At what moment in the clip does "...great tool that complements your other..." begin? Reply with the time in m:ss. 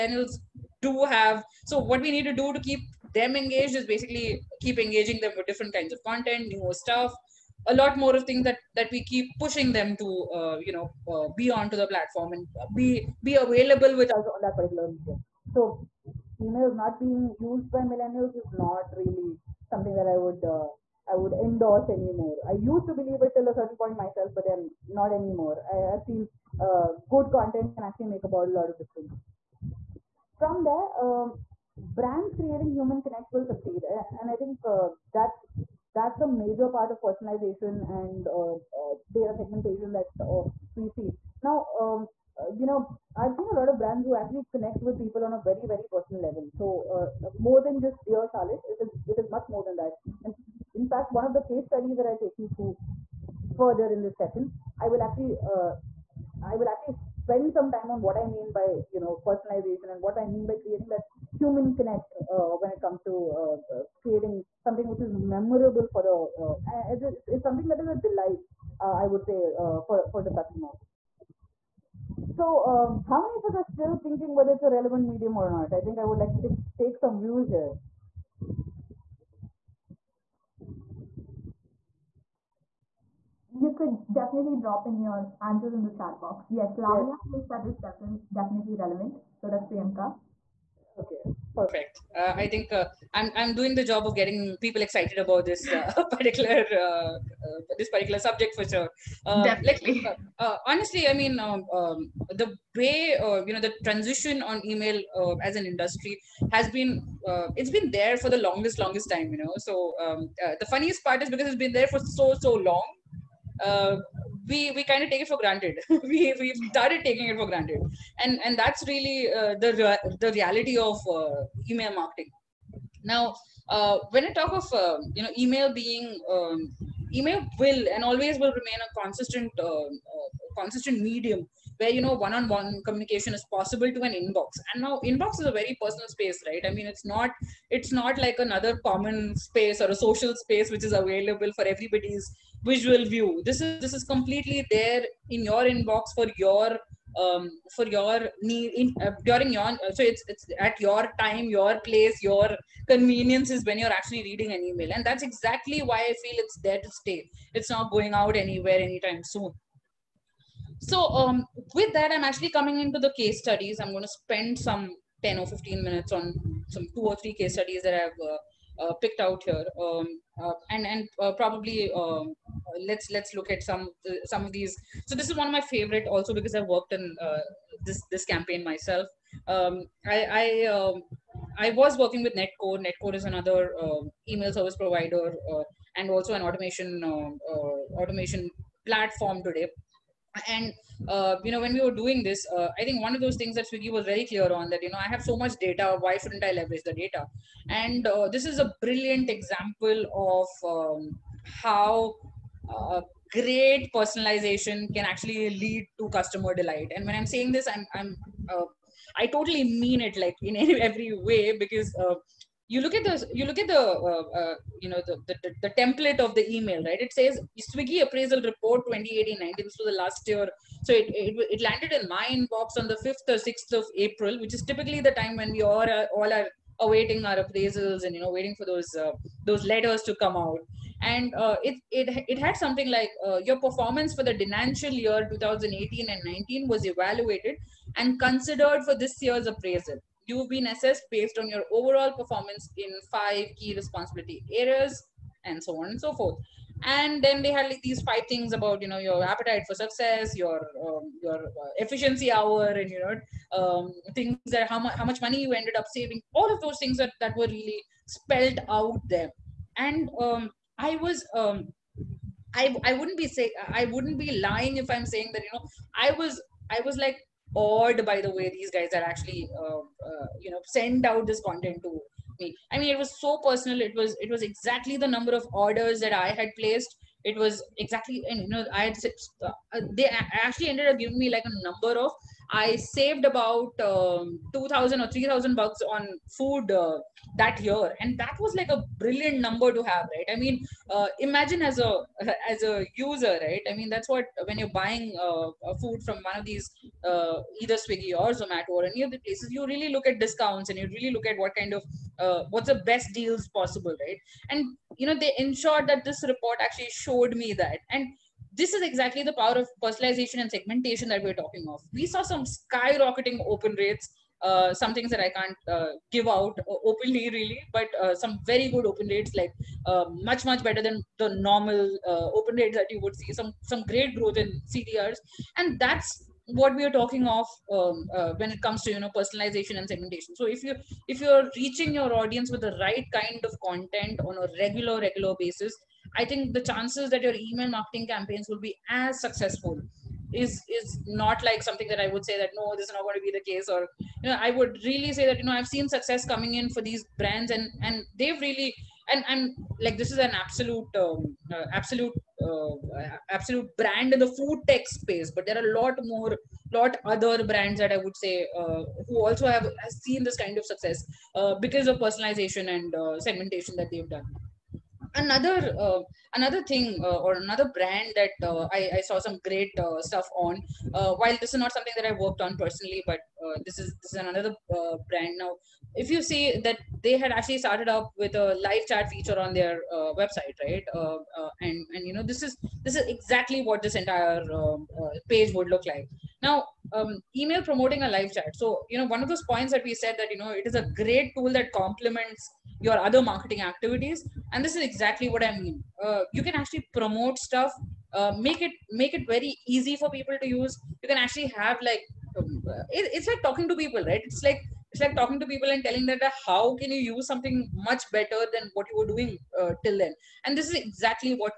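6:31.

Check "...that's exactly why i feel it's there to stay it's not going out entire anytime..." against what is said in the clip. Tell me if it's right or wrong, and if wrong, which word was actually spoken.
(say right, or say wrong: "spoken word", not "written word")
wrong: "anywhere", not "entire".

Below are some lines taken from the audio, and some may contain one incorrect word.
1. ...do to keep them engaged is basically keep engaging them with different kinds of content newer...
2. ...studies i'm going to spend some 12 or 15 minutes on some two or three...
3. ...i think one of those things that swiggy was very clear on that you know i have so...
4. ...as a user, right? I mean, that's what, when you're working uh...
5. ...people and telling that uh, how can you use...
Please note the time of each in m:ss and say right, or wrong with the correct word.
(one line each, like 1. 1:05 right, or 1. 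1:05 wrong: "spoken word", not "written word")
1. 0:02 right
2. 2:43 wrong: "10", not "12"
3. 3:12 right
4. 4:52 wrong: "buying", not "working"
5. 6:45 right.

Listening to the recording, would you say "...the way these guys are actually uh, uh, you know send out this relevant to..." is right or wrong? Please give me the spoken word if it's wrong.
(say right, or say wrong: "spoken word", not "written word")
wrong: "content", not "relevant".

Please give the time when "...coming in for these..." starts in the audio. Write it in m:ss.
5:46.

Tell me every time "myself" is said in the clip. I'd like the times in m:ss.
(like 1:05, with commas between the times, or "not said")
0:24, 2:58.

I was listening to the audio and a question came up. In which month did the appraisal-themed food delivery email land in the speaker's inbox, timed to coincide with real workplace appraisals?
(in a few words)
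April.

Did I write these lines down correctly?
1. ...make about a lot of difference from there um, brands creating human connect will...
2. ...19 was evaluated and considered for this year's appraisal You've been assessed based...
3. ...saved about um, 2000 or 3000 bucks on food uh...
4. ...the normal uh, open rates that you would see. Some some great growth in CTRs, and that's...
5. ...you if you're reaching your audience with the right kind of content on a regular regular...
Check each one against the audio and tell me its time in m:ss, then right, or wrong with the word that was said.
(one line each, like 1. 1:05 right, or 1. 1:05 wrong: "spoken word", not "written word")
1. 0:28 right
2. 3:56 right
3. 4:42 right
4. 5:21 right
5. 5:30 right.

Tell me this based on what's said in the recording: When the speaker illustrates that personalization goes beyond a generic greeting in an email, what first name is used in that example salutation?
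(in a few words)
Charlotte.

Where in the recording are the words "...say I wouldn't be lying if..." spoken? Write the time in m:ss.
4:23.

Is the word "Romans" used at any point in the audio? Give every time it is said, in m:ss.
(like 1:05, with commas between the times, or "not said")
not said.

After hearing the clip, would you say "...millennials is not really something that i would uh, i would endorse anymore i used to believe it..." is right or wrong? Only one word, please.
right.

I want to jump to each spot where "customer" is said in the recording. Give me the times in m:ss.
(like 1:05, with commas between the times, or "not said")
1:10, 3:26.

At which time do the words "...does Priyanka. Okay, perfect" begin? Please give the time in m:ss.
1:29.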